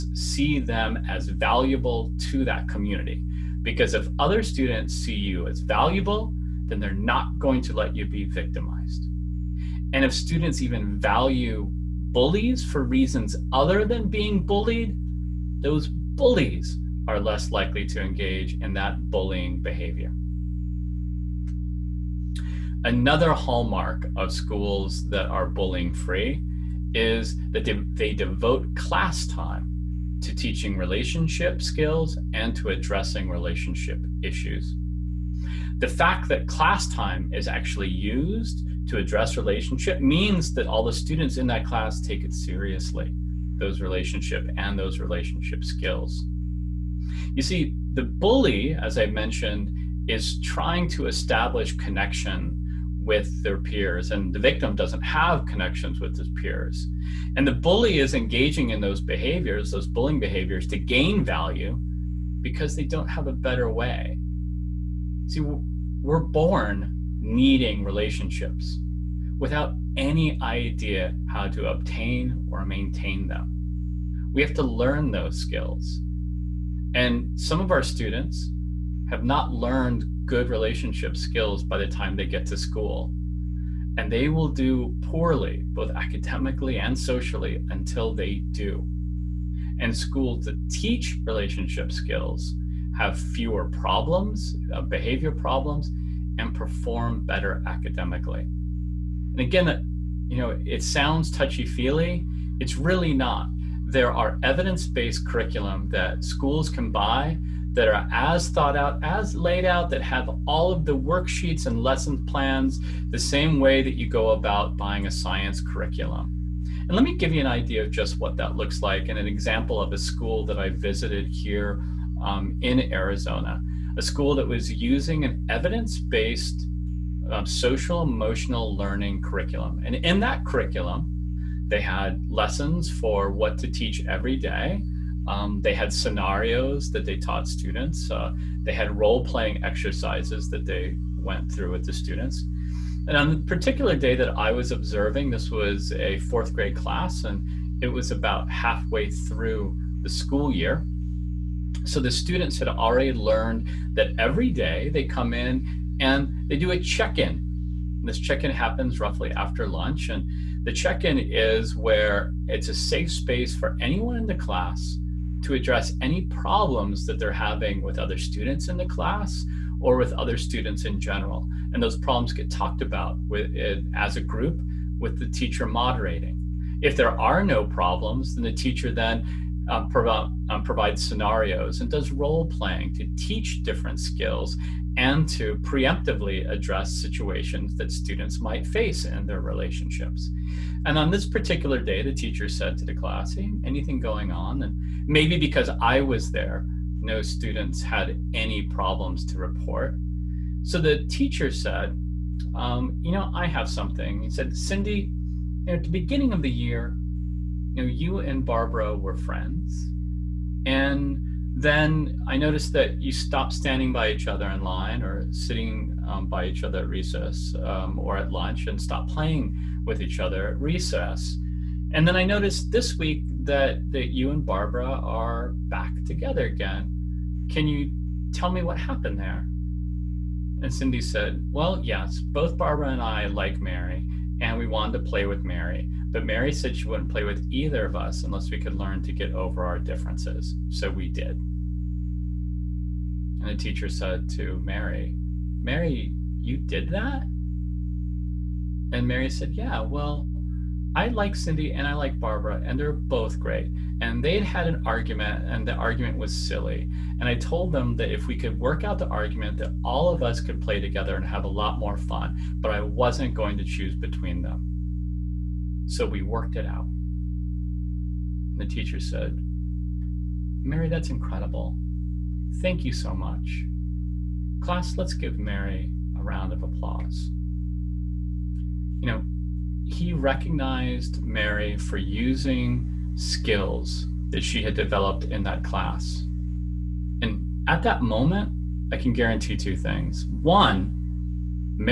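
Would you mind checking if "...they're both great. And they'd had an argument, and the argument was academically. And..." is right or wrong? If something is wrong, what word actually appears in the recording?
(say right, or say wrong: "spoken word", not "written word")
wrong: "silly", not "academically".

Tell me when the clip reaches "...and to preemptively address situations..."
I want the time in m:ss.
3:04.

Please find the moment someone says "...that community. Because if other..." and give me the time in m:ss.
0:02.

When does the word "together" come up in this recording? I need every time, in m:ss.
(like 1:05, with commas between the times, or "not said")
3:46, 4:20.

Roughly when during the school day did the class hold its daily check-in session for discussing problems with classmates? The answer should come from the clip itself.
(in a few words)
After lunch.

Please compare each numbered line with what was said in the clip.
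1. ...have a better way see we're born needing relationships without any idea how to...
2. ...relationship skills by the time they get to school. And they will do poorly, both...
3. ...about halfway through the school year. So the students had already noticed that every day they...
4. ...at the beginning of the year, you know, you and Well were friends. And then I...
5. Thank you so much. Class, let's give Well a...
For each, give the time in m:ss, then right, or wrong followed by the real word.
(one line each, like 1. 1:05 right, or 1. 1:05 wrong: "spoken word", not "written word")
1. 1:03 right
2. 1:20 right
3. 2:28 wrong: "learned", not "noticed"
4. 3:25 wrong: "Barbara", not "Well"
5. 4:32 wrong: "Mary", not "Well".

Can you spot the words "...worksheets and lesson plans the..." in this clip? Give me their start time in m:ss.
1:50.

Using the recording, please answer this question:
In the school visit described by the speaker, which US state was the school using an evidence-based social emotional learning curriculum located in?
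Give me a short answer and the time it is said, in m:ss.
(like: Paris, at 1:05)
Arizona, at 2:02.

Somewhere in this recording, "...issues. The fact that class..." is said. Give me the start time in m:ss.
0:34.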